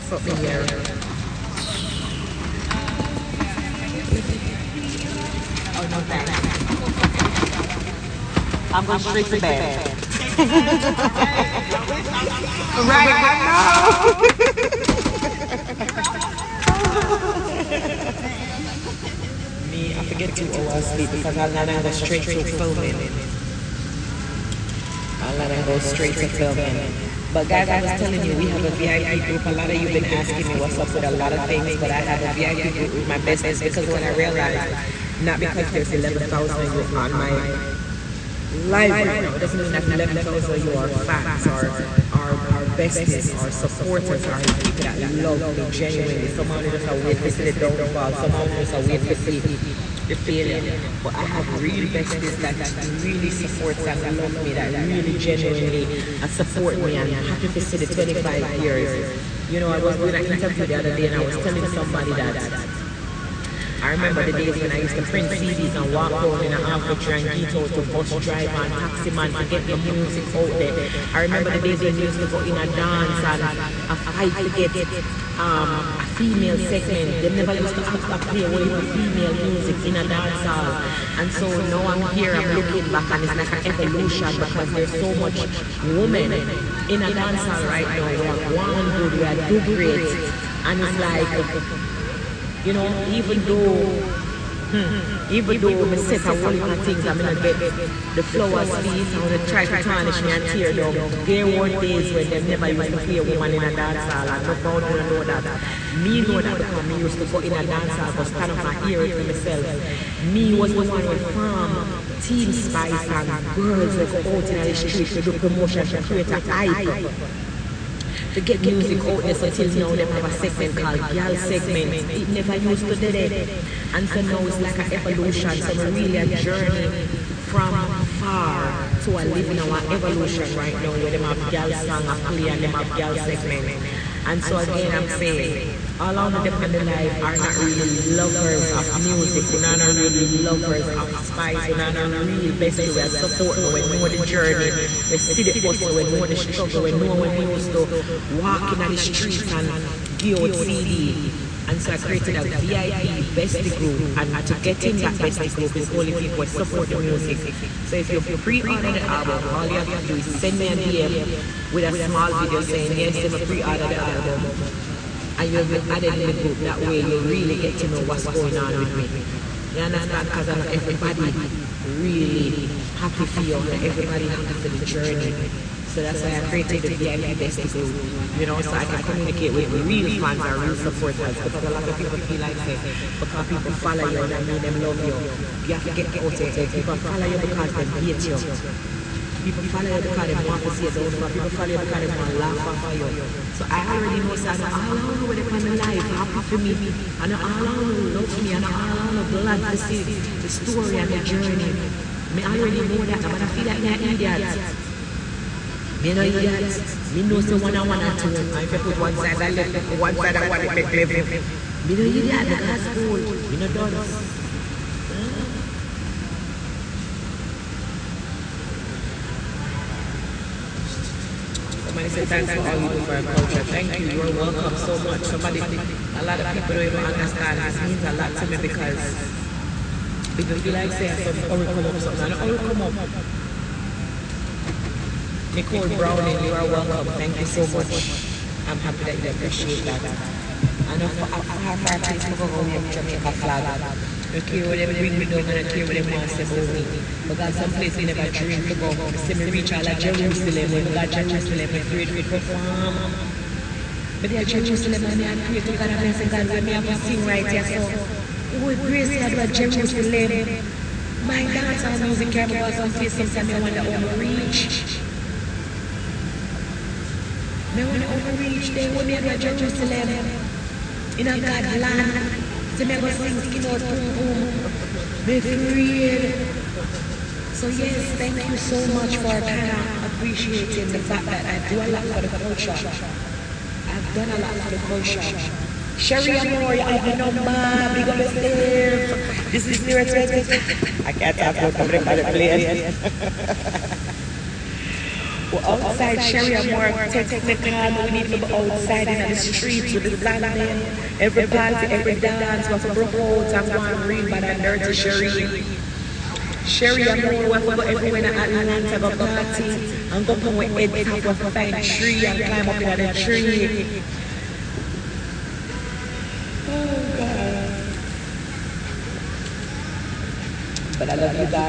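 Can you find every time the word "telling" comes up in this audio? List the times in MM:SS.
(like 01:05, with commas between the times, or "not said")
00:27, 01:01.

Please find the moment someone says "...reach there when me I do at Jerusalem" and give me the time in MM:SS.
04:28.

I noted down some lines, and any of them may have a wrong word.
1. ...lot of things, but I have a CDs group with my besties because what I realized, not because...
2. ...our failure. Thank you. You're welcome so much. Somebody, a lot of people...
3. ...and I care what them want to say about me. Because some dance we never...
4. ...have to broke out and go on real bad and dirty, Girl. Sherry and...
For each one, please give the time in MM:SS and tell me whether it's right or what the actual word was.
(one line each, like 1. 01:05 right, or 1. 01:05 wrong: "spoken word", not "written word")
1. 00:31 wrong: "VIP", not "CDs"
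2. 03:43 wrong: "culture", not "failure"
3. 04:05 wrong: "place", not "dance"
4. 05:02 wrong: "Sherry", not "Girl".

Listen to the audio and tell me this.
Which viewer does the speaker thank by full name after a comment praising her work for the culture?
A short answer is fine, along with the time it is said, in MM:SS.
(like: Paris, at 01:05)
Nicole Browning, at 03:55.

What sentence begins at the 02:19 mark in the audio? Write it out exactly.
We're not really lovers of spice.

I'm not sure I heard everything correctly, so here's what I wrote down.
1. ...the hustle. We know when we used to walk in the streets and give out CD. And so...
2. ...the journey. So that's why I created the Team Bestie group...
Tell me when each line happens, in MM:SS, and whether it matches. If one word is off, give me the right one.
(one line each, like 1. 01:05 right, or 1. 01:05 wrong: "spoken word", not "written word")
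1. 02:26 wrong: "struggle", not "hustle"
2. 02:54 wrong: "VIP", not "Team".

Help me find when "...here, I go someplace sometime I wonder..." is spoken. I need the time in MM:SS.
04:22.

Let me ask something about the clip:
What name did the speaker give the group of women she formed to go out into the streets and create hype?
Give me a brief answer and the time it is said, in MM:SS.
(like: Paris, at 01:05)
Team Spice, at 01:52.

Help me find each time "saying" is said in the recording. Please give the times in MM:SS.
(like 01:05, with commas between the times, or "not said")
02:15, 02:42.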